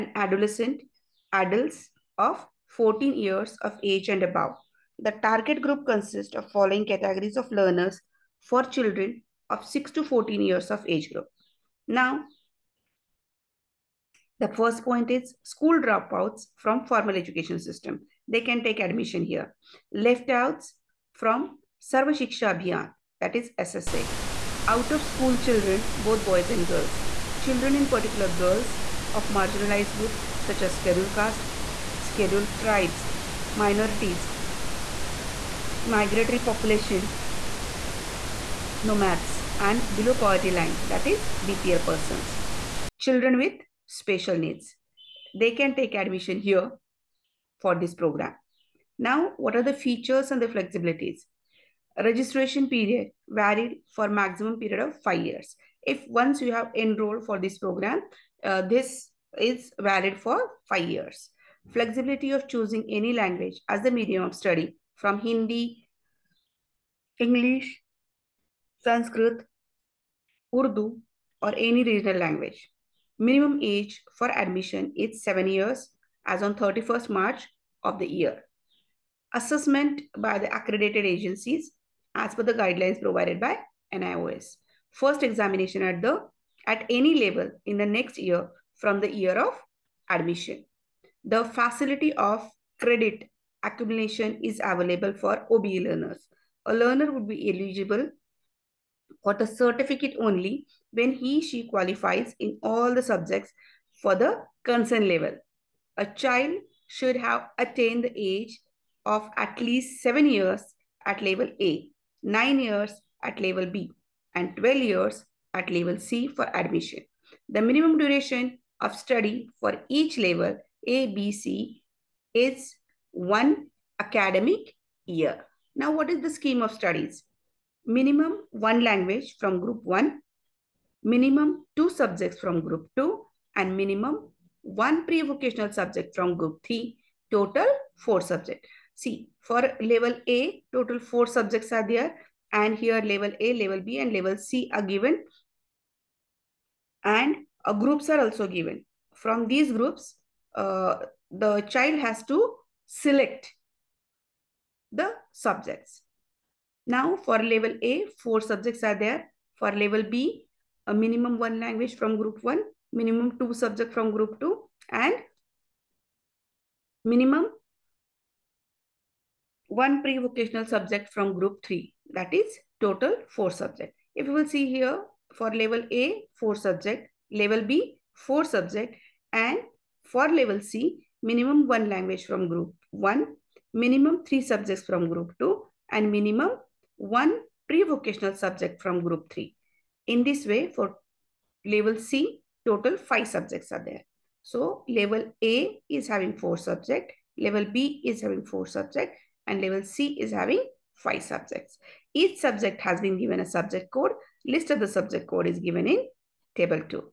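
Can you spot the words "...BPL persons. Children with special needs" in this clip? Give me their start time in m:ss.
0:41.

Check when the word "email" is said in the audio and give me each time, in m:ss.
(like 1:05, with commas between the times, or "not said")
not said.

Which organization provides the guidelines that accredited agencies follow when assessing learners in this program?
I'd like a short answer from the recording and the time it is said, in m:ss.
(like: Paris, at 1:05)
NIOS, at 1:23.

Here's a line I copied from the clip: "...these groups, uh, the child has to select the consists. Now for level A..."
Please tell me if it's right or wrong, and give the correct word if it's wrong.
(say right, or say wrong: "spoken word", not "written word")
wrong: "subjects", not "consists".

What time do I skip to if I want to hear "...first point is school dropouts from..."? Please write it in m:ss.
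0:14.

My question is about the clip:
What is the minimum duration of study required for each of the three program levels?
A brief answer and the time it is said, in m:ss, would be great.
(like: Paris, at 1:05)
One academic year, at 2:03.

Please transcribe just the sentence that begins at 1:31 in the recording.
The facility of credit accumulation is available for OBE learners.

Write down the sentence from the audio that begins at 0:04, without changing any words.
The target group consists of following categories of learners for children of 6 to 14 years of age group.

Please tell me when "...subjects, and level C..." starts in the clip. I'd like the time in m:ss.
3:18.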